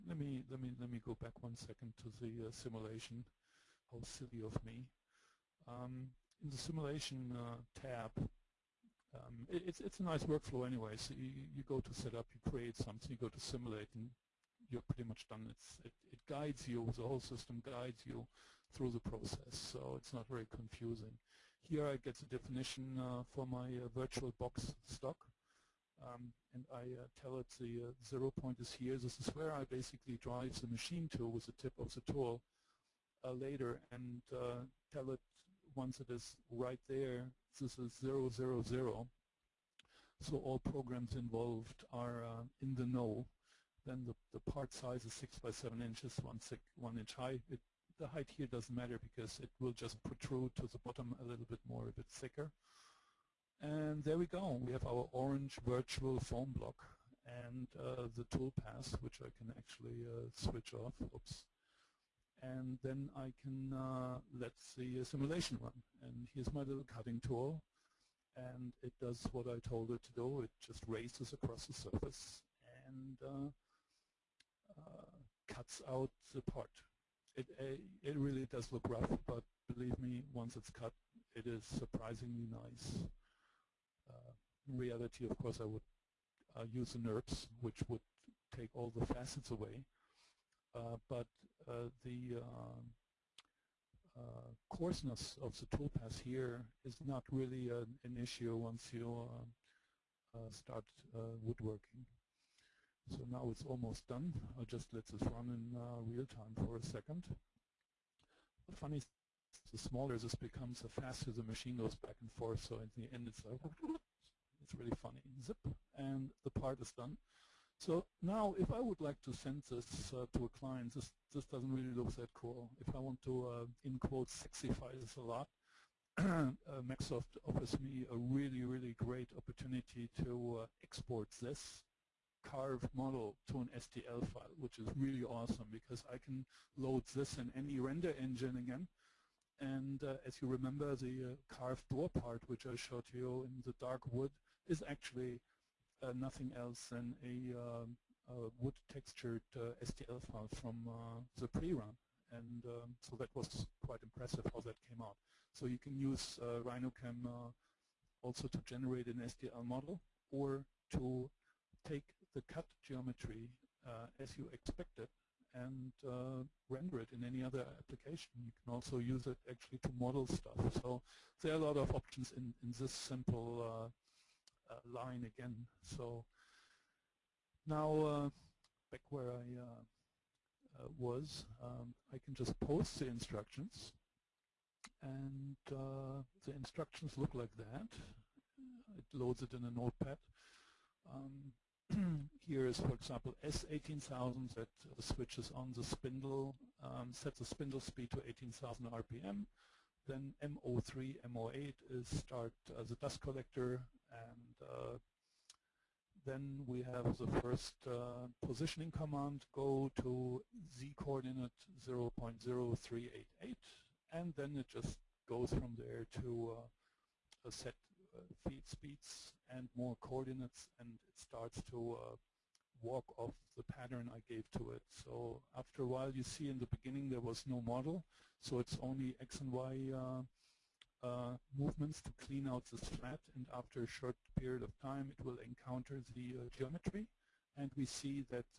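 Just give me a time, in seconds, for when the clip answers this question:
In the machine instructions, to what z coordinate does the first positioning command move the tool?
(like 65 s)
211 s.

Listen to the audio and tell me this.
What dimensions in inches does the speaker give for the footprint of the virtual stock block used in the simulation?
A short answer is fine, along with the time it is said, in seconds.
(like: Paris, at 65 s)
6 by 7 inches, at 45 s.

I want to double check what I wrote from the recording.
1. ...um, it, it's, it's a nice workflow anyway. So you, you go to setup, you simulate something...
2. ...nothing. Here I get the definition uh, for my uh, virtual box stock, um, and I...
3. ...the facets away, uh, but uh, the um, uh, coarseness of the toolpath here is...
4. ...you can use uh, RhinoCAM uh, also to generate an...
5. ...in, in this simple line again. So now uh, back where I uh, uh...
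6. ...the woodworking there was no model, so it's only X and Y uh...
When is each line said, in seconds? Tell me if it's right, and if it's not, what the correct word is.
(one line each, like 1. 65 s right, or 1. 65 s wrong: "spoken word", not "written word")
1. 9 s wrong: "create", not "simulate"
2. 20 s wrong: "confusing", not "nothing"
3. 88 s right
4. 155 s right
5. 172 s right
6. 226 s wrong: "beginning", not "woodworking".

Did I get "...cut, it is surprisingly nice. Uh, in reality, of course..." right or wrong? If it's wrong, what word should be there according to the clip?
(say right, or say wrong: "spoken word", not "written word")
right.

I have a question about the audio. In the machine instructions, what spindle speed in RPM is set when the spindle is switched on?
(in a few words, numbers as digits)
18,000 RPM.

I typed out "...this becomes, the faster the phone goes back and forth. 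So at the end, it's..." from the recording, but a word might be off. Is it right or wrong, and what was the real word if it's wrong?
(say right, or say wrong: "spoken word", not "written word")
wrong: "machine", not "phone".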